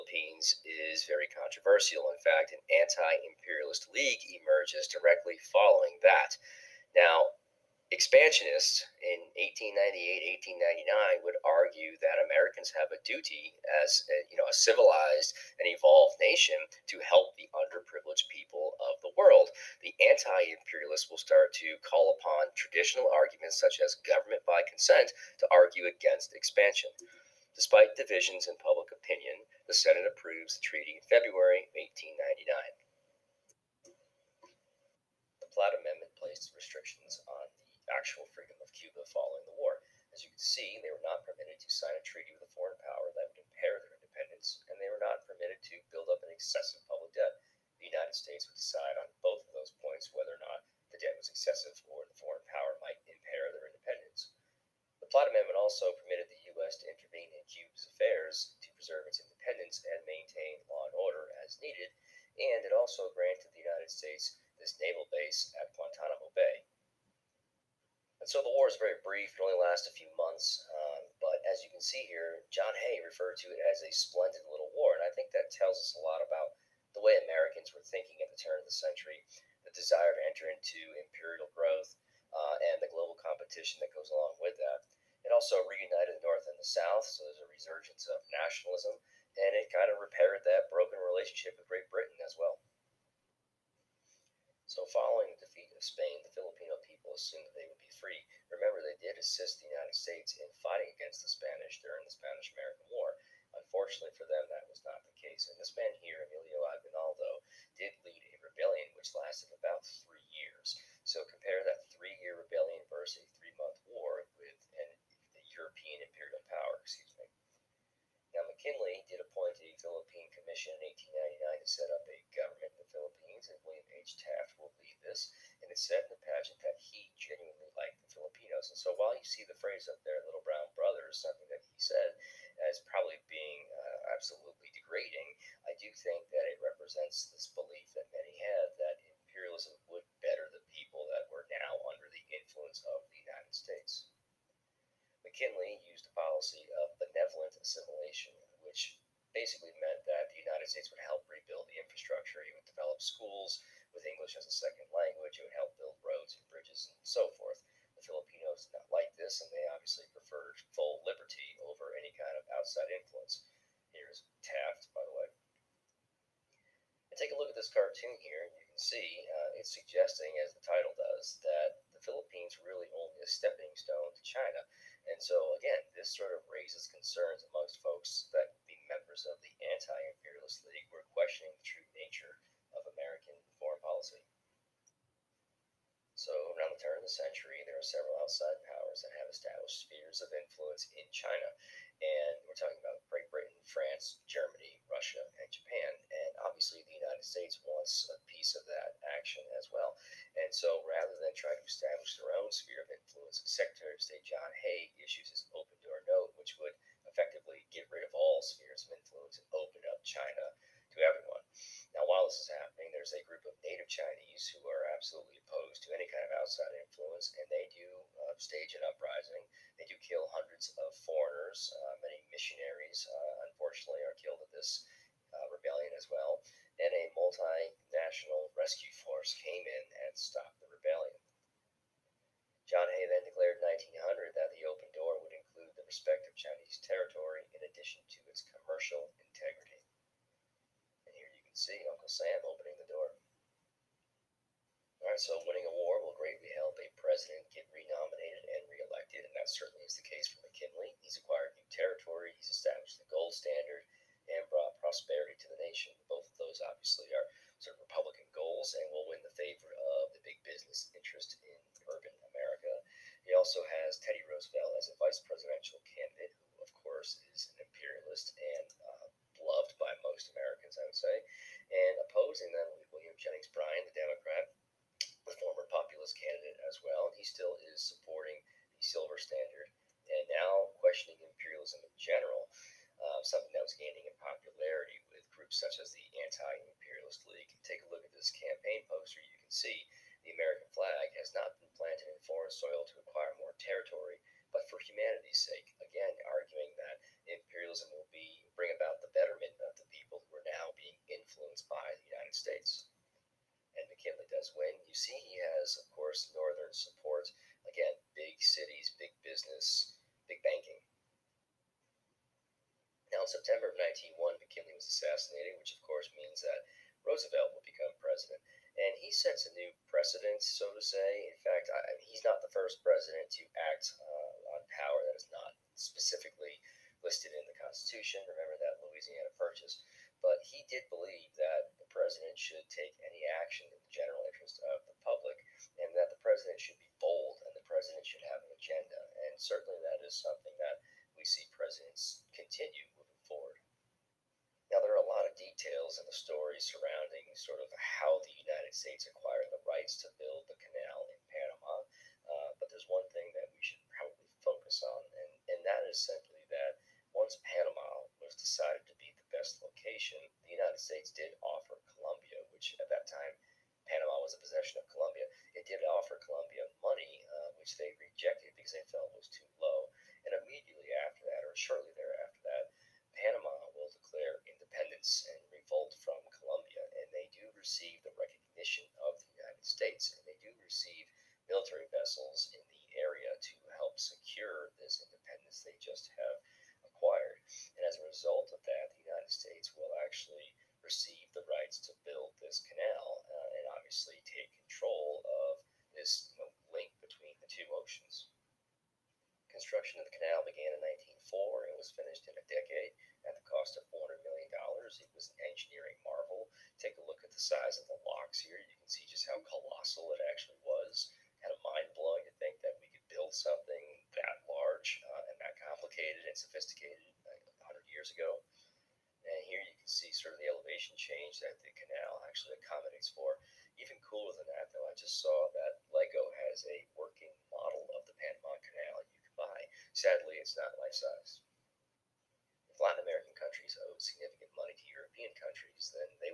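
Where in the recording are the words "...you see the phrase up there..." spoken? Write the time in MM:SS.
02:09.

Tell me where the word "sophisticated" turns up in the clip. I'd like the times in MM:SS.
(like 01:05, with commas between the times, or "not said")
06:56.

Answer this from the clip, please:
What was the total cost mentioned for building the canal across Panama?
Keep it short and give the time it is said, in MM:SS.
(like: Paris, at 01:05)
$400 million, at 06:43.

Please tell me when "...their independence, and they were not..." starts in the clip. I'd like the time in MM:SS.
00:43.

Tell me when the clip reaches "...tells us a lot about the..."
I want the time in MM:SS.
01:15.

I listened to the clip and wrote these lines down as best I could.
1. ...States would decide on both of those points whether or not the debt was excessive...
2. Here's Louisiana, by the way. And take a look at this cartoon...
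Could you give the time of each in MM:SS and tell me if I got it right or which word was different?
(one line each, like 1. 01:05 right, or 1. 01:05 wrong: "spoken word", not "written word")
1. 00:48 right
2. 02:43 wrong: "Taft", not "Louisiana".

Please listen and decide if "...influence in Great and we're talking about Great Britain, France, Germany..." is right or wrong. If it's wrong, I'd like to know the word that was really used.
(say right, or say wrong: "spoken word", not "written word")
wrong: "China", not "Great".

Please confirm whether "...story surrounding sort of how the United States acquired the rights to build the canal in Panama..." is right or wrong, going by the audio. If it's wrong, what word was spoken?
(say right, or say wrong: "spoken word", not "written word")
right.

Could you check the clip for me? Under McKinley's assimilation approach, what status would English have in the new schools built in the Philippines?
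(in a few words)
Second language.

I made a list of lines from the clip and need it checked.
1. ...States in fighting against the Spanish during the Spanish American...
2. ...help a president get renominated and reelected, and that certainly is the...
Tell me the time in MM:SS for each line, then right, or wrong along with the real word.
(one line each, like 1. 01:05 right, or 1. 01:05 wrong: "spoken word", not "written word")
1. 01:39 right
2. 04:06 right.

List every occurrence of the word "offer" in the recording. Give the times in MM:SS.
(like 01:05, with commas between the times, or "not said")
06:01, 06:05.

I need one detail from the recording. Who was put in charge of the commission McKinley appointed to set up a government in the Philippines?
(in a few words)
William H. Taft.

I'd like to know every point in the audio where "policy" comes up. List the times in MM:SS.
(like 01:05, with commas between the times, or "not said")
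02:26, 03:03.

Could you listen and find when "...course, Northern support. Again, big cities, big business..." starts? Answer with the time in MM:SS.
05:05.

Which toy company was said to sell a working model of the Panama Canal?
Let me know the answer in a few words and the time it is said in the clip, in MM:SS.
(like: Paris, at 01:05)
LEGO, at 07:05.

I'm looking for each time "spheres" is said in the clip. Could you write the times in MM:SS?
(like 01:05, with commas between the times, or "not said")
03:09, 03:22, 03:28.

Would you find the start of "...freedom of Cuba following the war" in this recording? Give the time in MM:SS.
00:38.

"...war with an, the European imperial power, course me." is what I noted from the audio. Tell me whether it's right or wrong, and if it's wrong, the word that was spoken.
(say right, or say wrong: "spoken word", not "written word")
wrong: "excuse", not "course".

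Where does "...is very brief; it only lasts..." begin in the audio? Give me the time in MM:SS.
01:08.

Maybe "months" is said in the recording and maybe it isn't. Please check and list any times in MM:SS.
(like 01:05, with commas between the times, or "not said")
01:10, 01:53.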